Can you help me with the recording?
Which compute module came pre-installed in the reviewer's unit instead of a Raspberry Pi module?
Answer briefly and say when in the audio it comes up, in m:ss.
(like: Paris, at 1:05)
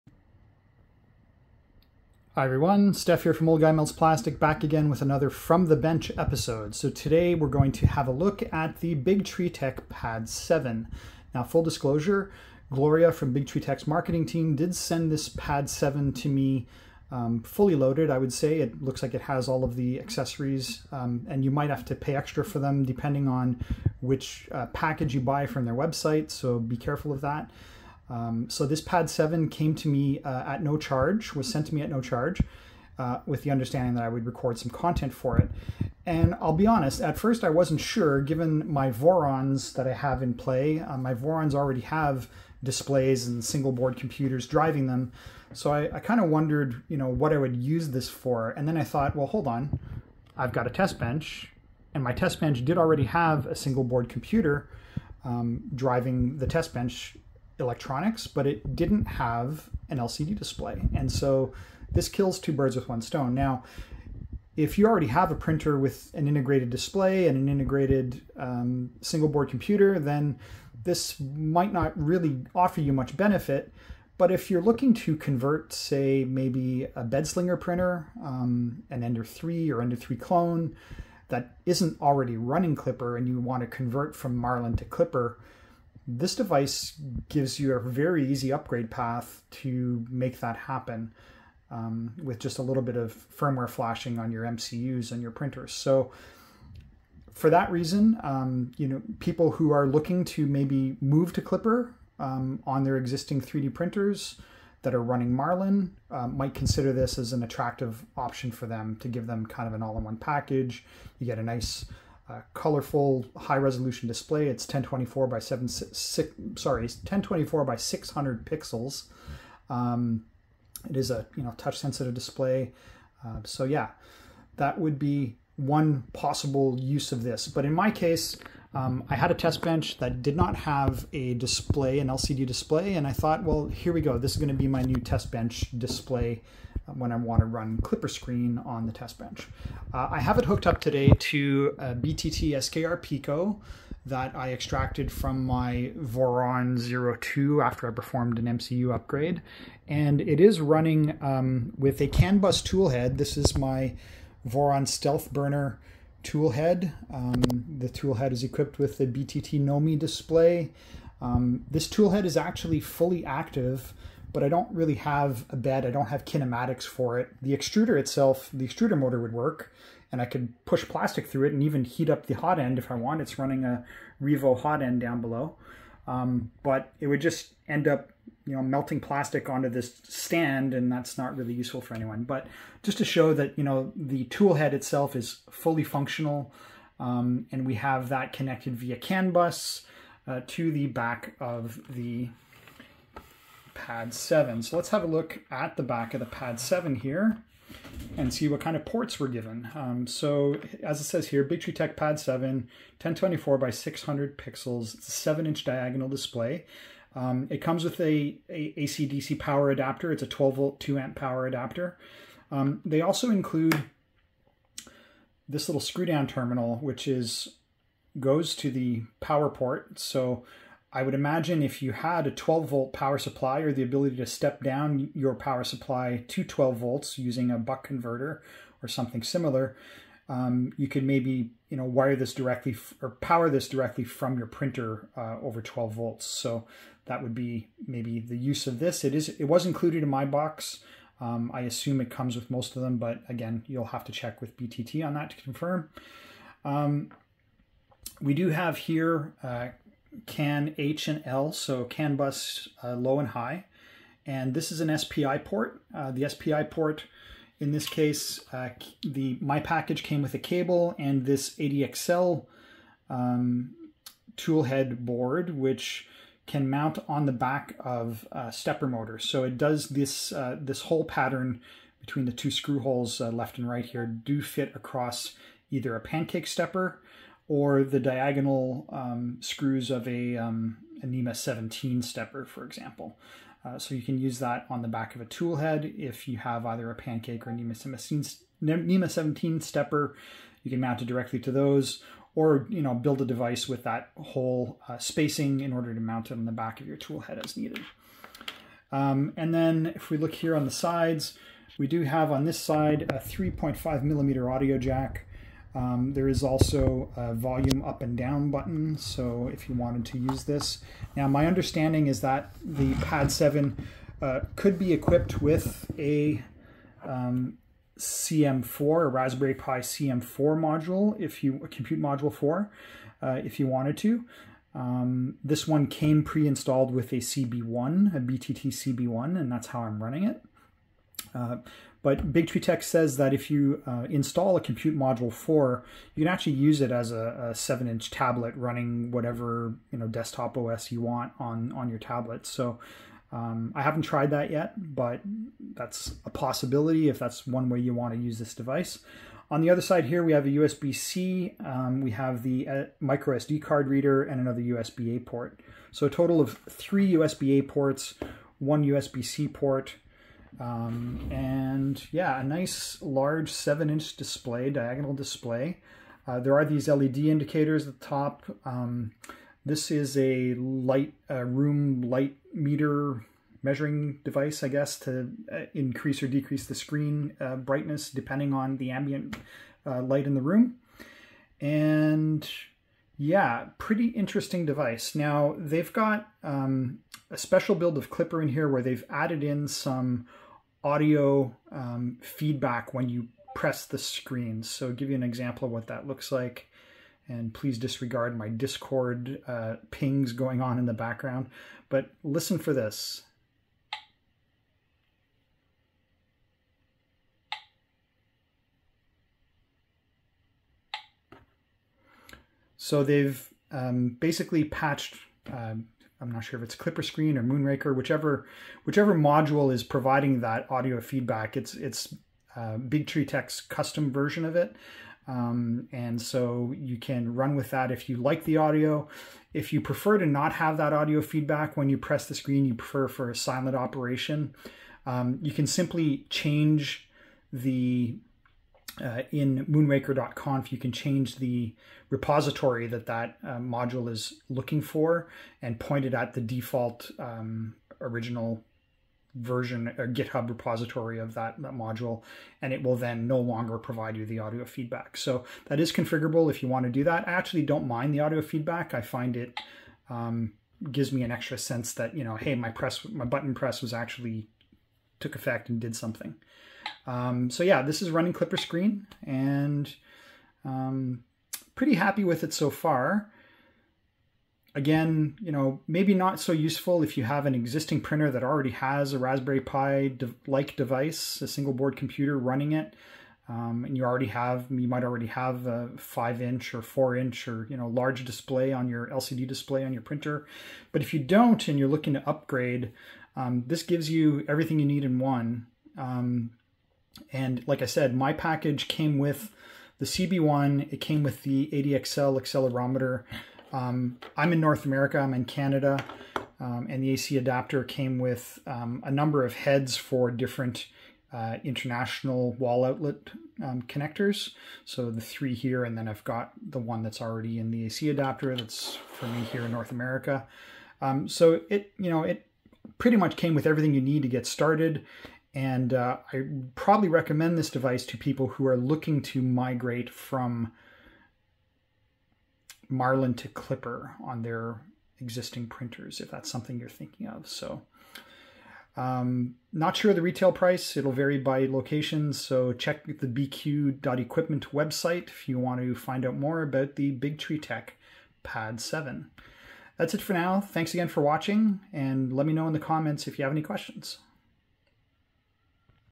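BTT CB1, at 5:28.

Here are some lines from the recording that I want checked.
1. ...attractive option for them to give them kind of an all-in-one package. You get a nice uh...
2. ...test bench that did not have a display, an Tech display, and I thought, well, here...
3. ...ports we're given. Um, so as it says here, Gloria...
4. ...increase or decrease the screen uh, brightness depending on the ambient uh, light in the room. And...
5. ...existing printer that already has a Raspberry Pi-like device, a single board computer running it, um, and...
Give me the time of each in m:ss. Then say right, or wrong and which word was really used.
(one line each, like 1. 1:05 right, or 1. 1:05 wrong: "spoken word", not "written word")
1. 1:47 right
2. 2:09 wrong: "LCD", not "Tech"
3. 3:18 wrong: "Big", not "Gloria"
4. 6:15 right
5. 7:57 right.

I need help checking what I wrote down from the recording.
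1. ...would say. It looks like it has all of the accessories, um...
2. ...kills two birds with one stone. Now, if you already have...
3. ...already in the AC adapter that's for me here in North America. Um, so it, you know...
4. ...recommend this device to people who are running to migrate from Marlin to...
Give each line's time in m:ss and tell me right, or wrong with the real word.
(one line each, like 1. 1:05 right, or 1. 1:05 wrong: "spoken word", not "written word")
1. 0:18 right
2. 1:02 right
3. 8:37 right
4. 8:47 wrong: "looking", not "running".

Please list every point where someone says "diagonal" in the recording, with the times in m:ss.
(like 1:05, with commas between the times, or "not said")
3:25, 4:37, 6:04.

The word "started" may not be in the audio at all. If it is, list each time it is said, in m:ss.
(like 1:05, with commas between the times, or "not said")
8:44.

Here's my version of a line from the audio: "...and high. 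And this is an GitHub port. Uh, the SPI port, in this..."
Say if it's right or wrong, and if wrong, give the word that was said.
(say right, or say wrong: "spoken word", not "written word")
wrong: "SPI", not "GitHub".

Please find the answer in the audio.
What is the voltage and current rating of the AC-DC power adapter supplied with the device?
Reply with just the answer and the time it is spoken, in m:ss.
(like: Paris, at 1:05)
12 volt 2 amp, at 3:30.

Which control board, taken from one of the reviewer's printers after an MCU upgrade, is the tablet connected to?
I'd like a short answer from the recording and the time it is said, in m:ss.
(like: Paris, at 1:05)
BTT SKR Pico, at 2:21.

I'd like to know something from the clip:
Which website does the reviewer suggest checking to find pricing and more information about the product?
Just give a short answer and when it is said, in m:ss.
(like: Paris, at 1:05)
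biqu.equipment, at 9:03.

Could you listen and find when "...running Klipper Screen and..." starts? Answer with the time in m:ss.
7:48.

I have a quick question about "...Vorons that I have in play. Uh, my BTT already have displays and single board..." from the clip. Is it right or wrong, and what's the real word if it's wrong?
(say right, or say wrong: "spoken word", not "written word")
wrong: "Vorons", not "BTT".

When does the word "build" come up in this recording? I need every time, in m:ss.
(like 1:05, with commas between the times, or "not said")
4:52, 6:27.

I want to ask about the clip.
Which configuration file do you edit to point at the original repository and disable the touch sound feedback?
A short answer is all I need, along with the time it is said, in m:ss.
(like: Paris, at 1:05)
moonraker.conf, at 7:19.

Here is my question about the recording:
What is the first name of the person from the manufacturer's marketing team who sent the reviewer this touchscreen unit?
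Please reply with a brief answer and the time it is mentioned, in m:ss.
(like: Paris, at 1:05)
Gloria, at 0:12.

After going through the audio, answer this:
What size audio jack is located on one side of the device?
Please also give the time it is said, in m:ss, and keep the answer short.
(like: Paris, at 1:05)
3.5 millimeter, at 5:03.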